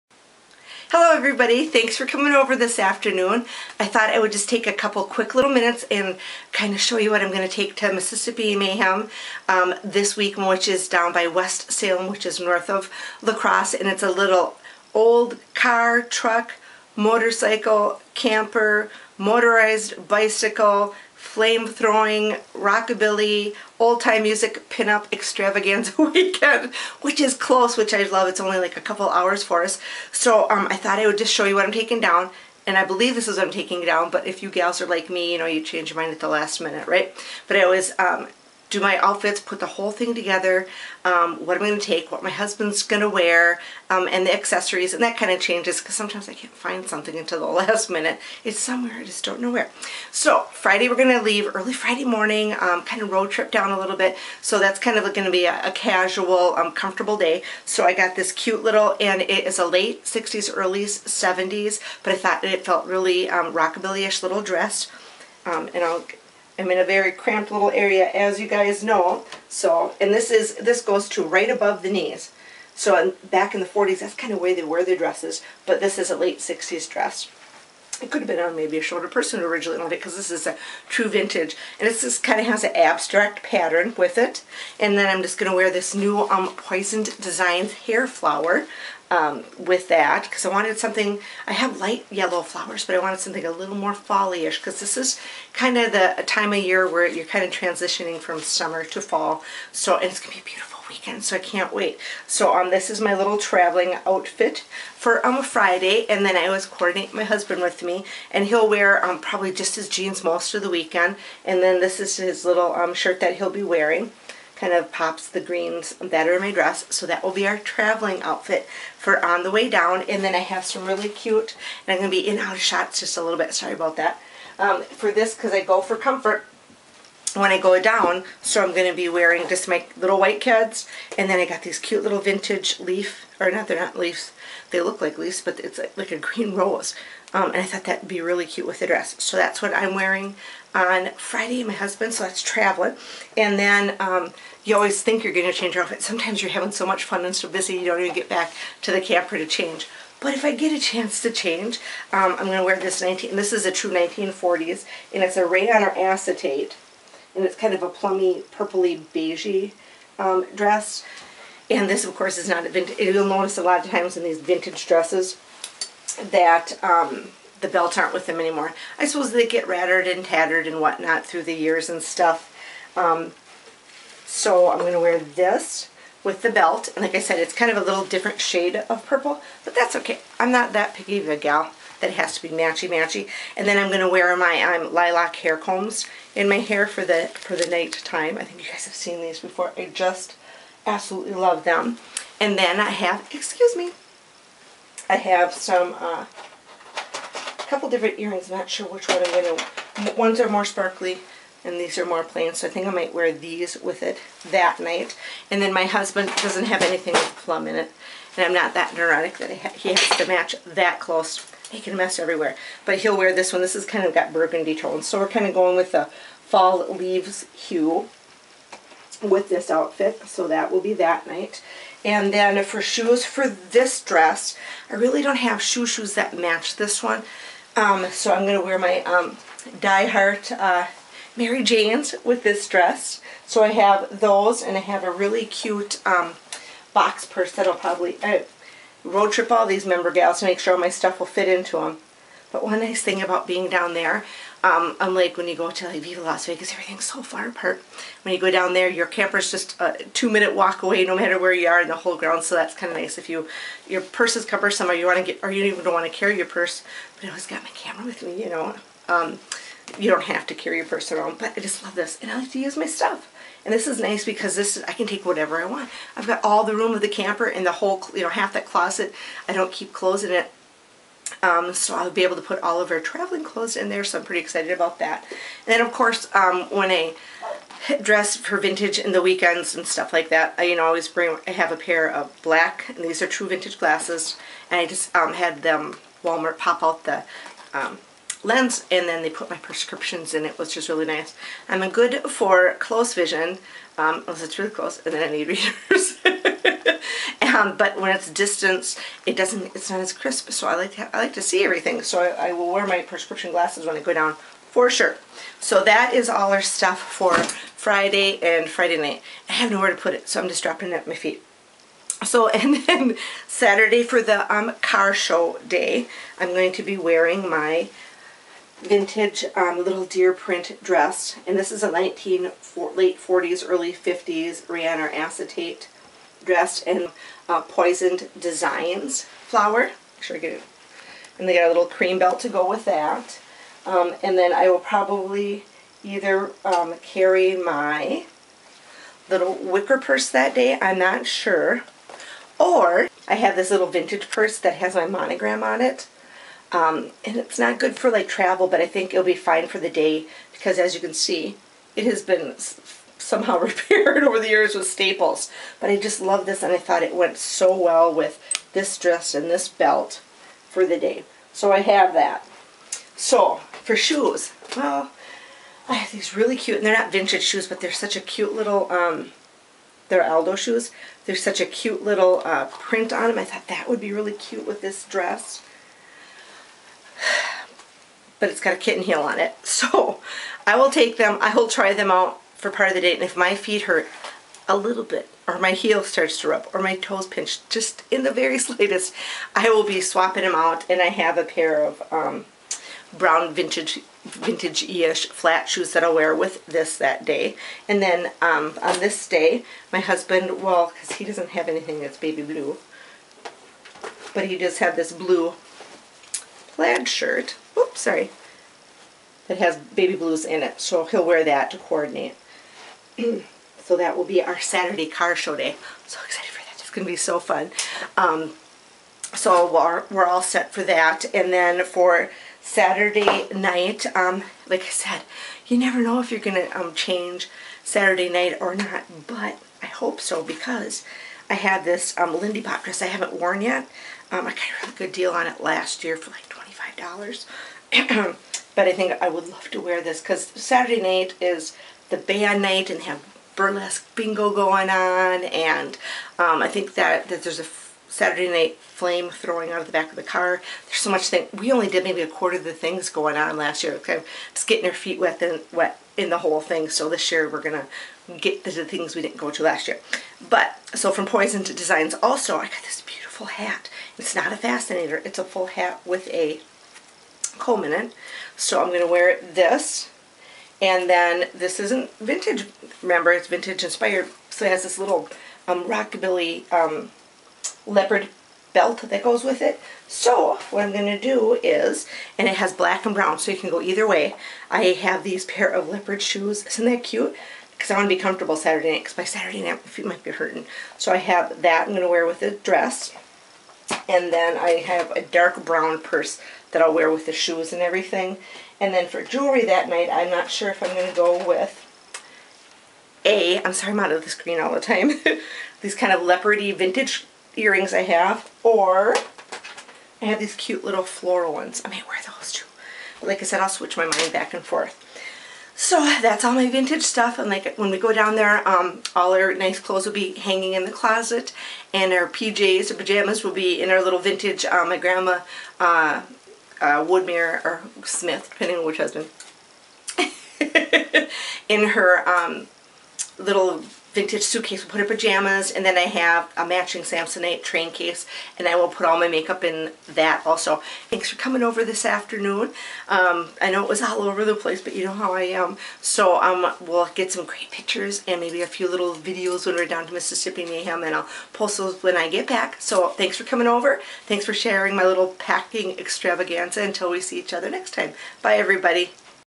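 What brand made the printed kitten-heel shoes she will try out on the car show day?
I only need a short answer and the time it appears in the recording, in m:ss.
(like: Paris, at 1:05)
Aldo, at 6:10.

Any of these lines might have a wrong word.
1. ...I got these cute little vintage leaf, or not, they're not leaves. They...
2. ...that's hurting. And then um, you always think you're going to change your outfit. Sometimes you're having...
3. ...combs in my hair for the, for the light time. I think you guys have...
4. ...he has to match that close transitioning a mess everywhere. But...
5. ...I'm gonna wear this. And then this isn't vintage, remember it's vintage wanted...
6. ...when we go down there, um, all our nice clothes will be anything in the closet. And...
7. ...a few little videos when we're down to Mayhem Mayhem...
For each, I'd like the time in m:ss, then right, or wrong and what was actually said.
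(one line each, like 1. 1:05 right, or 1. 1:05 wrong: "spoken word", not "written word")
1. 2:11 right
2. 2:22 wrong: "traveling", not "hurting"
3. 3:05 wrong: "night", not "light"
4. 3:29 wrong: "making", not "transitioning"
5. 7:48 wrong: "inspired", not "wanted"
6. 8:37 wrong: "hanging", not "anything"
7. 9:08 wrong: "Mississippi", not "Mayhem".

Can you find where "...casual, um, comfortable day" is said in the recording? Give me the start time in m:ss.
0:55.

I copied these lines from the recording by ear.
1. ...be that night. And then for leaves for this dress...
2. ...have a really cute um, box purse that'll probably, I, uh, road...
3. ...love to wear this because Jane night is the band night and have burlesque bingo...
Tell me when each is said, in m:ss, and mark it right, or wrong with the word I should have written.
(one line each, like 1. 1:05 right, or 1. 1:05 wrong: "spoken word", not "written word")
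1. 3:40 wrong: "shoes", not "leaves"
2. 3:54 right
3. 7:19 wrong: "Saturday", not "Jane".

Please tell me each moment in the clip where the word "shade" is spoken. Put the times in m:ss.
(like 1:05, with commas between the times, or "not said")
2:58.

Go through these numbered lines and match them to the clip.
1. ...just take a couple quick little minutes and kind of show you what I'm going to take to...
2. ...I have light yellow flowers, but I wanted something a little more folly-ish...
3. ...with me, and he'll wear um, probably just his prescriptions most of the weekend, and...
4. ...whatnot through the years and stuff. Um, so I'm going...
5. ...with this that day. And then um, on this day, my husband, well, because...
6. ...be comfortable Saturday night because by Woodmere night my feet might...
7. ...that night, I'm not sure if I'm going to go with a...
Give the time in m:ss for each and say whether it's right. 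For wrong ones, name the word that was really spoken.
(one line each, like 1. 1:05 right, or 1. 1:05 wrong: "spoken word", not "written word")
1. 0:04 right
2. 1:31 right
3. 1:47 wrong: "jeans", not "prescriptions"
4. 2:50 right
5. 6:36 right
6. 8:08 wrong: "Saturday", not "Woodmere"
7. 8:19 right.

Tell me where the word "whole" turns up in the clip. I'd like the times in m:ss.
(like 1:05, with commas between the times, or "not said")
0:39, 4:11, 4:27, 7:36.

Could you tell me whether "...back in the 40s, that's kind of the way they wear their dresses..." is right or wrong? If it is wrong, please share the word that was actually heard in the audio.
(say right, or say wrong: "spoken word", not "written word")
right.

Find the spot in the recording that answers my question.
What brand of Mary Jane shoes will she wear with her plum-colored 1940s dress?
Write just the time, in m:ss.
3:49.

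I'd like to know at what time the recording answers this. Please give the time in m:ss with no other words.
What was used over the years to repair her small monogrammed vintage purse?
5:54.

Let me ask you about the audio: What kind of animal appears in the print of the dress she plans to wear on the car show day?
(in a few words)
Deer.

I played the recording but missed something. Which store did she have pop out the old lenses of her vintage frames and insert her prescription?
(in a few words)
Walmart.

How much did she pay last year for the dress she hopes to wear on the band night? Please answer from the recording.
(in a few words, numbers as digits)
$25.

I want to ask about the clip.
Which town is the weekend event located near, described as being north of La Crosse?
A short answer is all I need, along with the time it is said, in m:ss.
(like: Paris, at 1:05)
West Salem, at 0:11.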